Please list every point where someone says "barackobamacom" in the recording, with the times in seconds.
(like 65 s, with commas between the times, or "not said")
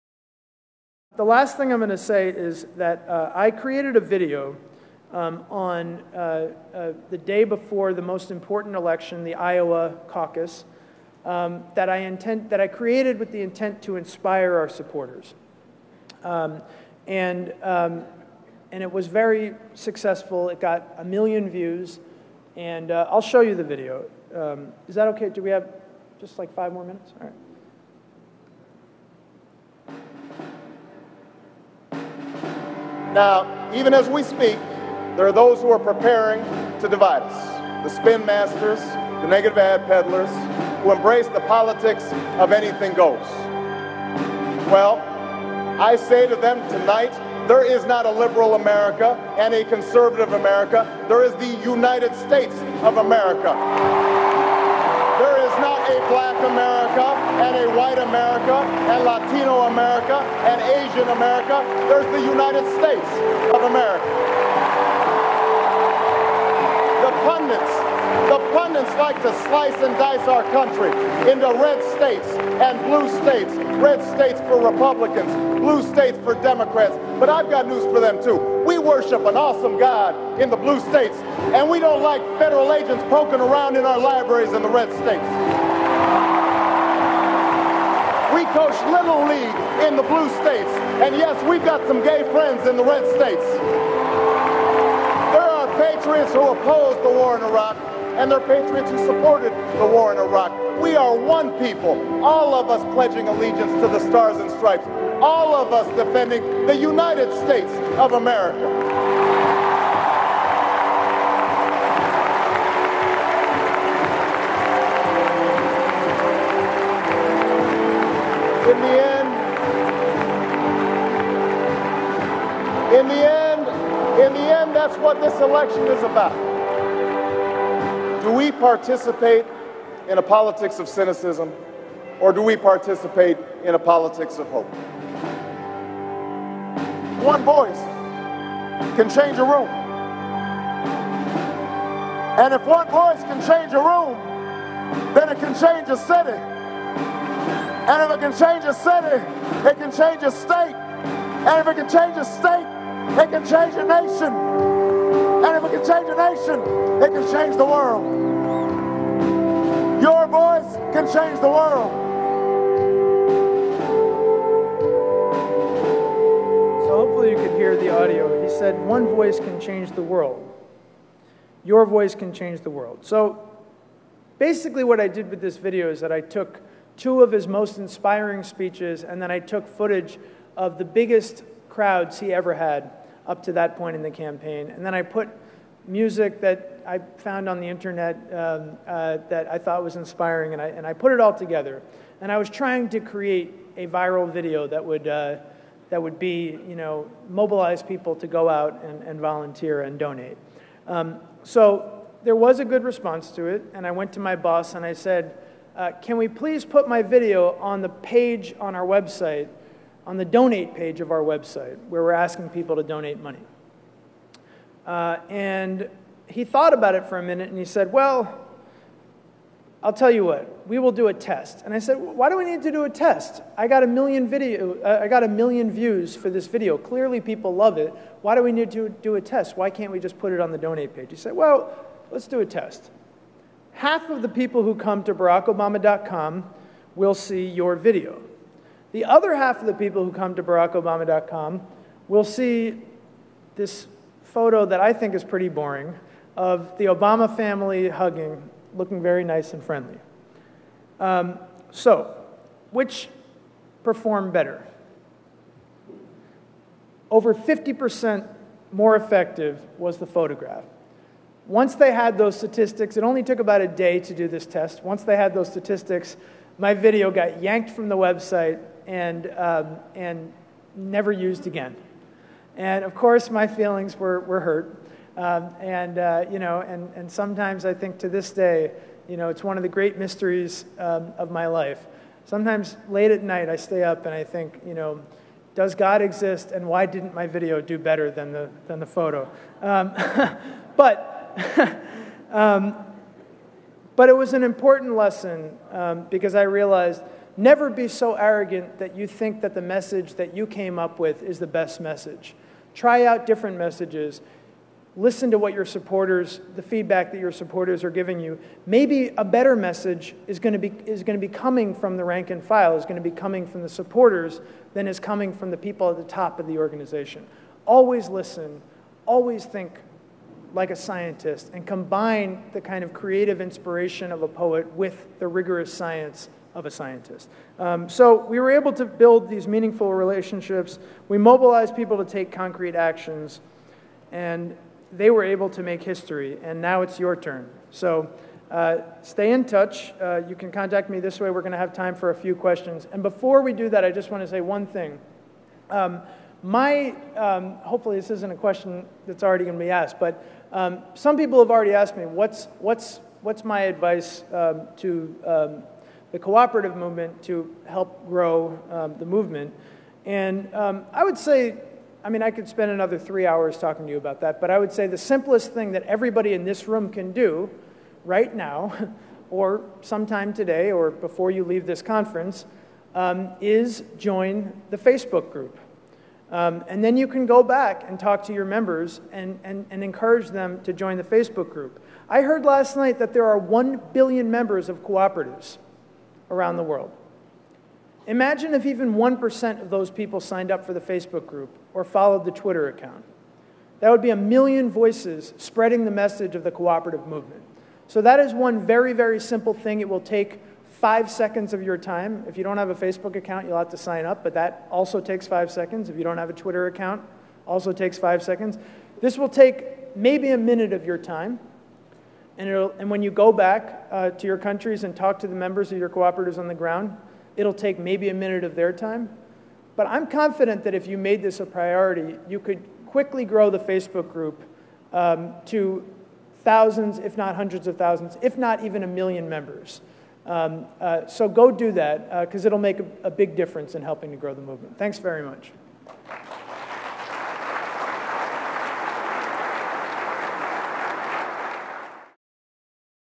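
235 s, 240 s.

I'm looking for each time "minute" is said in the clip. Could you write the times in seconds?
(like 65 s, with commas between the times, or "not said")
26 s, 217 s, 410 s, 418 s.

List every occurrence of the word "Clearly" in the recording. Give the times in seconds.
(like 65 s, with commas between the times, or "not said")
226 s.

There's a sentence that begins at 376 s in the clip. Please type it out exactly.
Um, and then you can go back and talk to your members and, and, and encourage them to join the Facebook group.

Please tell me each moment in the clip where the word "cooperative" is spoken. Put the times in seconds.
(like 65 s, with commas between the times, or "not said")
356 s, 384 s, 396 s, 415 s.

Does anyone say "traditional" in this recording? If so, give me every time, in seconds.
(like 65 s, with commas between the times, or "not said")
not said.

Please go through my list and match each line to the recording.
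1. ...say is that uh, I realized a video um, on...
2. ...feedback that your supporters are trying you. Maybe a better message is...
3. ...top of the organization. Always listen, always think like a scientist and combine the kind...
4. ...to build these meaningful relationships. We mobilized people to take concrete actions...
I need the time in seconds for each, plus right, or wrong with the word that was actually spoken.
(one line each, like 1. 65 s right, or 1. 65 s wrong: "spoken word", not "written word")
1. 1 s wrong: "created", not "realized"
2. 306 s wrong: "giving", not "trying"
3. 316 s right
4. 328 s right.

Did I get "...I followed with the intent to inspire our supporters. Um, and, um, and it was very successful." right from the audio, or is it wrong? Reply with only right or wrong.
wrong.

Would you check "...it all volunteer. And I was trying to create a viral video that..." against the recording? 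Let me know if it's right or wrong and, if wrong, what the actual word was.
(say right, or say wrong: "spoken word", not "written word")
wrong: "together", not "volunteer".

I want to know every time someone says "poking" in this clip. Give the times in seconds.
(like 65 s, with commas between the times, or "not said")
83 s.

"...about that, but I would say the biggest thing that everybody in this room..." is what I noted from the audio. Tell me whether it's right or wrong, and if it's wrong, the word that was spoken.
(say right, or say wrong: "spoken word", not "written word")
wrong: "simplest", not "biggest".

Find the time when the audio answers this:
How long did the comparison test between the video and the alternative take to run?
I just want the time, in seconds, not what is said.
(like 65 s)
263 s.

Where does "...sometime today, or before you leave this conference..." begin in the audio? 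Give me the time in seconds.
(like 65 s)
369 s.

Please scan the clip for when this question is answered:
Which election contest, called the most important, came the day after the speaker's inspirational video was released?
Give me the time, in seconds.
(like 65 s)
9 s.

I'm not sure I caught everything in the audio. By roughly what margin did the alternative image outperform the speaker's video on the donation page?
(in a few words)
over 50%.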